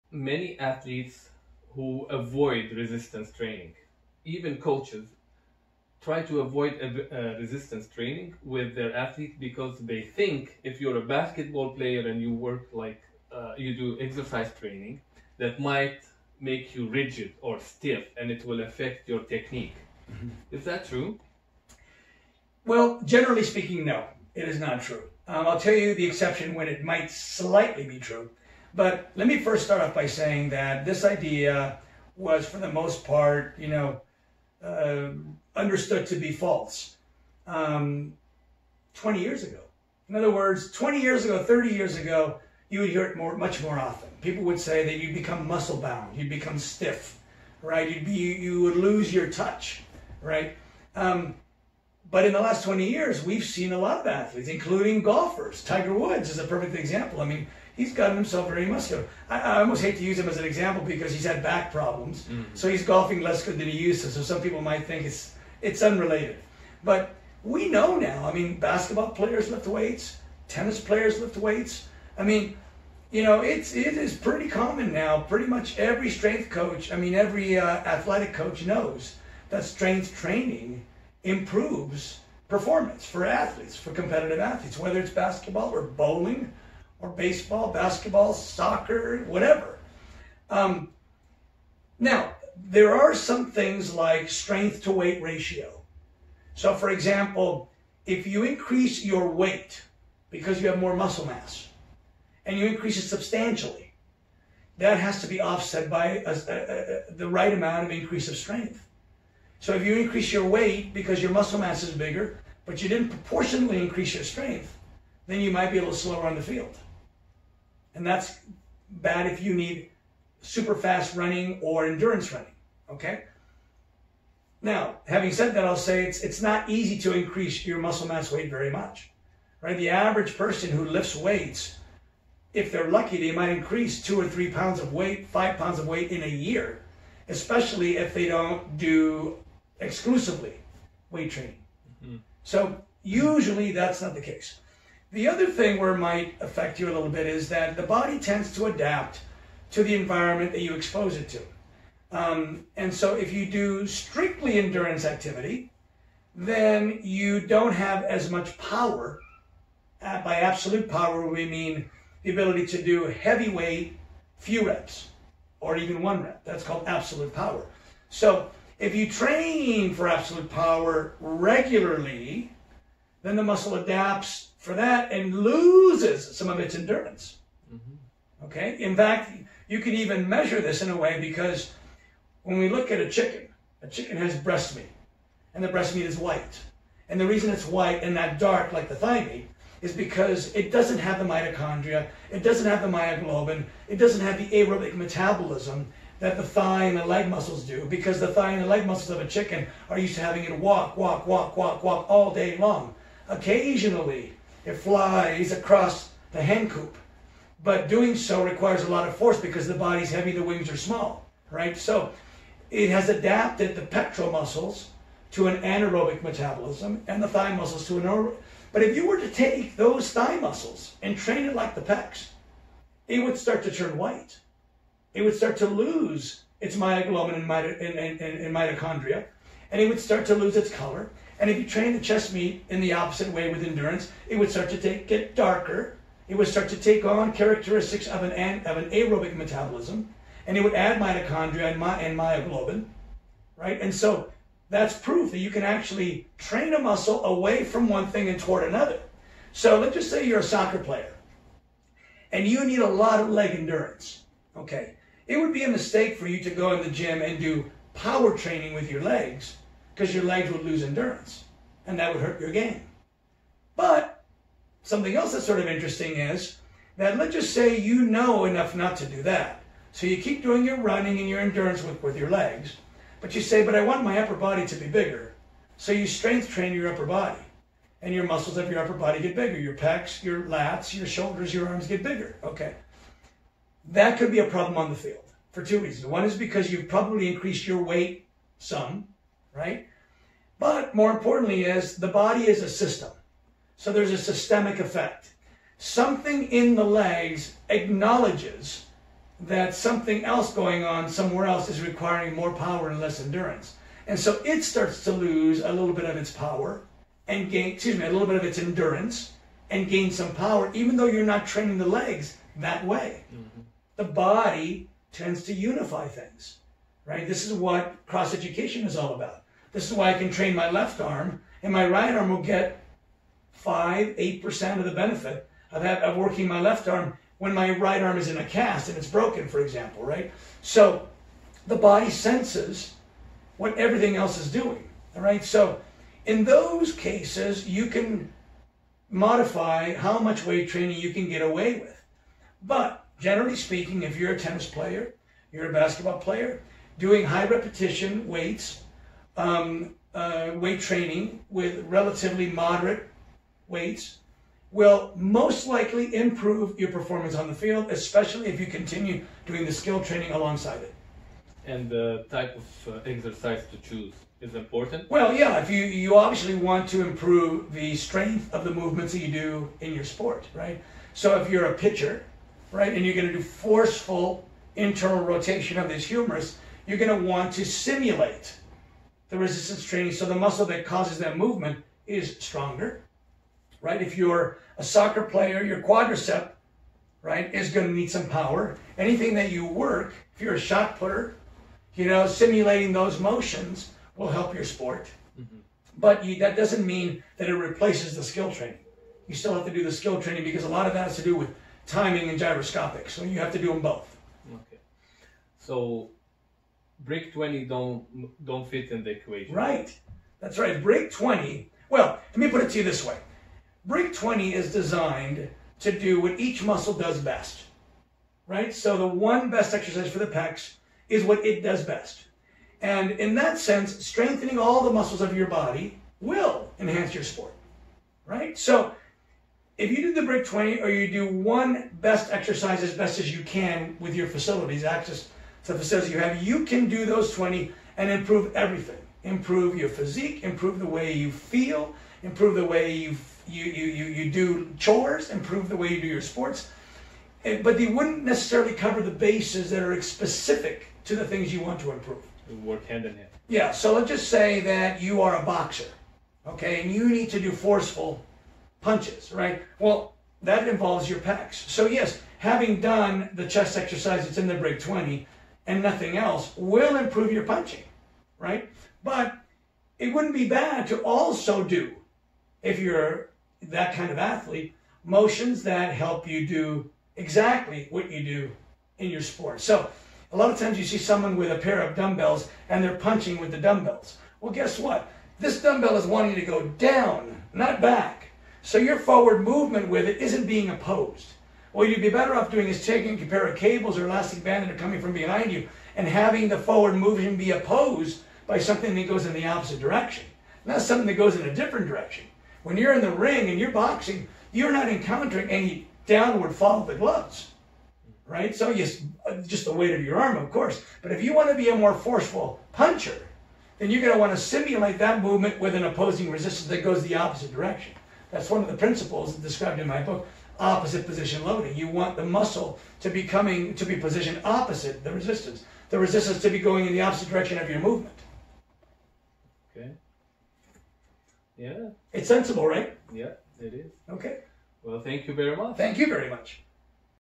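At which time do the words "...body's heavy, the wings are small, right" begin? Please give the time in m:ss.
3:29.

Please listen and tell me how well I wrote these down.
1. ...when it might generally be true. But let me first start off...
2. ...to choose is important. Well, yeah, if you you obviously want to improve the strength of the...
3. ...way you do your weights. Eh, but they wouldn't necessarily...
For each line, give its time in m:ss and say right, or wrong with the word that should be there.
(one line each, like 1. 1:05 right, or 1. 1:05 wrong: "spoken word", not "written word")
1. 0:26 wrong: "slightly", not "generally"
2. 6:03 right
3. 7:25 wrong: "sports", not "weights".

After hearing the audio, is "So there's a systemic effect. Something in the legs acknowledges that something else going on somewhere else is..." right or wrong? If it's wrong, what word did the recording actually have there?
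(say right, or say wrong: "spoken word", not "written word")
right.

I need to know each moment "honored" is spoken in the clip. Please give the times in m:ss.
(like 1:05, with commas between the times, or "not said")
not said.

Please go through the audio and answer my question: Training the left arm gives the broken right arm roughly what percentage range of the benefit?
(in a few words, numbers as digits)
5 to 8 percent.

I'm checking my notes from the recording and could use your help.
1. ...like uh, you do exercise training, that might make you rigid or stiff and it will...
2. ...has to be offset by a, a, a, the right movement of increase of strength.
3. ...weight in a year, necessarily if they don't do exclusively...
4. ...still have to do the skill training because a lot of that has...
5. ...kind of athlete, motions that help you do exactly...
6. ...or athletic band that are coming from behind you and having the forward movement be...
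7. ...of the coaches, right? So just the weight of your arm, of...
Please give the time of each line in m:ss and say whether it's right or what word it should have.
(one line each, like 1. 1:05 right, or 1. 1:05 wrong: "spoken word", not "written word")
1. 0:12 right
2. 1:44 wrong: "amount", not "movement"
3. 2:15 wrong: "especially", not "necessarily"
4. 6:39 right
5. 7:53 right
6. 8:13 wrong: "elastic", not "athletic"
7. 8:26 wrong: "gloves", not "coaches".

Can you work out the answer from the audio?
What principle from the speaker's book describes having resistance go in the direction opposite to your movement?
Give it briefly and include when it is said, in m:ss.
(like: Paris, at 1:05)
opposite position loading, at 8:40.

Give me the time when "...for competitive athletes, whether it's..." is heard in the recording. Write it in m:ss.
1:23.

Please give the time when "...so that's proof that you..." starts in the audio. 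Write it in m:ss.
4:03.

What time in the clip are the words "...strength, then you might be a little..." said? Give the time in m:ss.
1:54.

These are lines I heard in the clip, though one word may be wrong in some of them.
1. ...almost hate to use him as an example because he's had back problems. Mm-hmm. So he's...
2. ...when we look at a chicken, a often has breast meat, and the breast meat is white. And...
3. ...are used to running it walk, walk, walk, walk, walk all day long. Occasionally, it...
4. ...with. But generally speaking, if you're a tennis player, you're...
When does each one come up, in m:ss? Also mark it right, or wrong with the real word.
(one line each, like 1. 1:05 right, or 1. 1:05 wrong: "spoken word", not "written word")
1. 0:59 right
2. 3:02 wrong: "chicken", not "often"
3. 3:19 wrong: "having", not "running"
4. 5:41 right.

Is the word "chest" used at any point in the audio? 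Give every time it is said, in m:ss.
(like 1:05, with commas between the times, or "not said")
3:51, 7:43.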